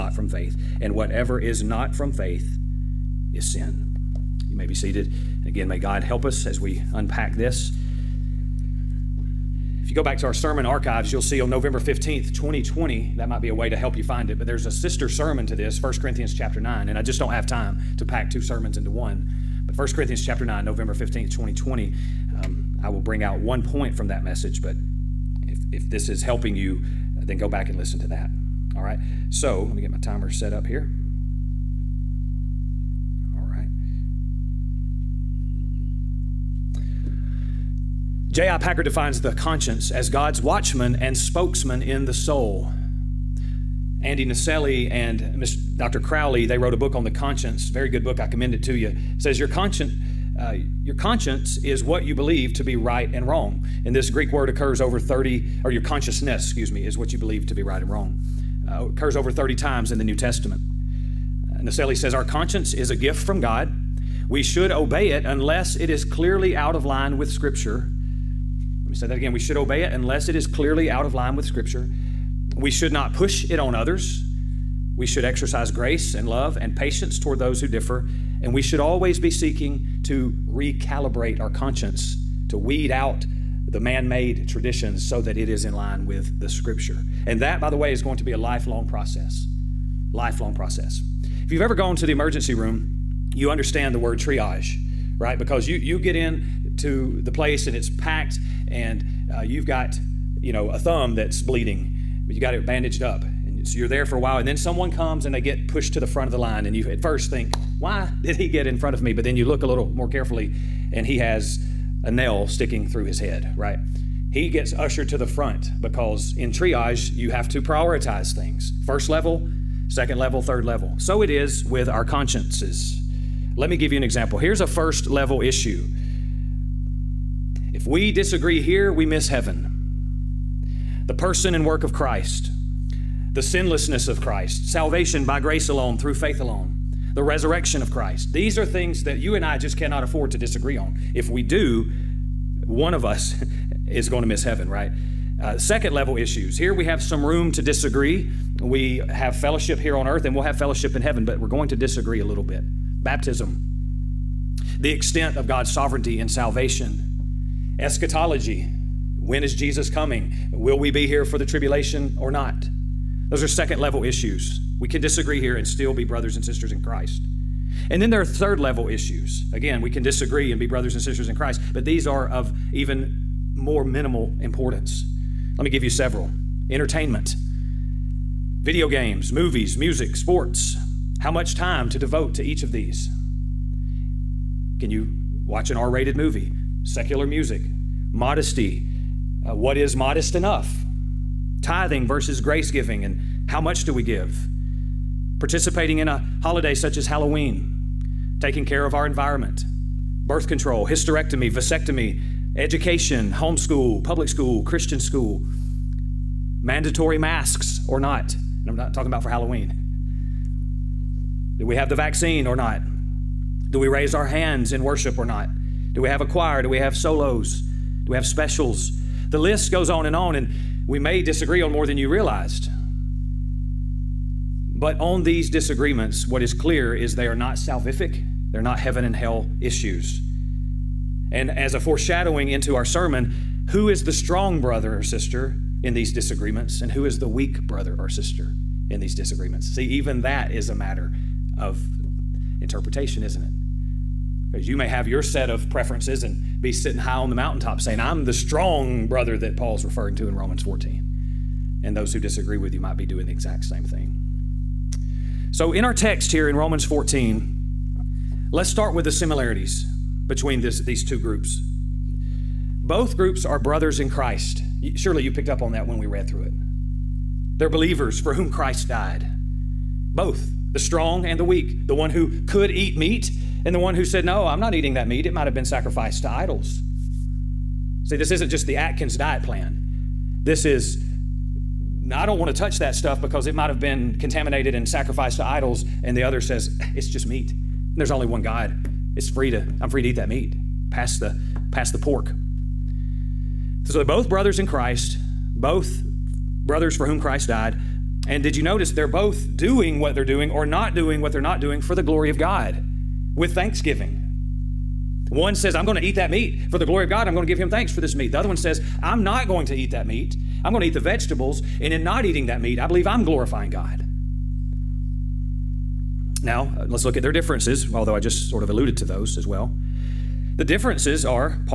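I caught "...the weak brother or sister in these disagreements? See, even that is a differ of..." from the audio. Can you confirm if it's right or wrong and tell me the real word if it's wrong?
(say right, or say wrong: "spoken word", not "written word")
wrong: "matter", not "differ".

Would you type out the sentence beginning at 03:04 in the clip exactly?
Can you watch an R rated movie?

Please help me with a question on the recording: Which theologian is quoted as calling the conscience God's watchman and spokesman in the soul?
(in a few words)
J.I. Packer.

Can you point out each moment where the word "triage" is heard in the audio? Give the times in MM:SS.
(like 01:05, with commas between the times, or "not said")
01:34, 01:56.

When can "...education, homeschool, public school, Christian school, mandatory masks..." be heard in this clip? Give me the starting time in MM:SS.
03:22.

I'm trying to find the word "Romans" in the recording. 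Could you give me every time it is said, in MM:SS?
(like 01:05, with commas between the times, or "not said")
04:10, 04:16.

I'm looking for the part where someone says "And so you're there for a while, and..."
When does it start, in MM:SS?
01:43.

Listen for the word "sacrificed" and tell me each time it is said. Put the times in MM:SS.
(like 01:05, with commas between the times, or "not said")
04:35, 04:44.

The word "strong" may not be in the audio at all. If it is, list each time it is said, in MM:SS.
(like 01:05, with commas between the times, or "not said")
03:54, 04:08, 04:30.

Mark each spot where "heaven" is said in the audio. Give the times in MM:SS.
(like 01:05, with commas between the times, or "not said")
02:09, 02:24, 02:31, 03:48.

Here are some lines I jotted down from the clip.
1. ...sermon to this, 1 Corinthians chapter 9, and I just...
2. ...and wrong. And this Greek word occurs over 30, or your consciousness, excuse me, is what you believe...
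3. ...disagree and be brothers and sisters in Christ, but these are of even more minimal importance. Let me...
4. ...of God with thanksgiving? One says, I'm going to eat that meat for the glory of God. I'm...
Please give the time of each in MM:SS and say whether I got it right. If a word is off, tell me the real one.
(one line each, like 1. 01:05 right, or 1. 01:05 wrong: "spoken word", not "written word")
1. 00:15 right
2. 00:53 right
3. 02:50 right
4. 05:02 right.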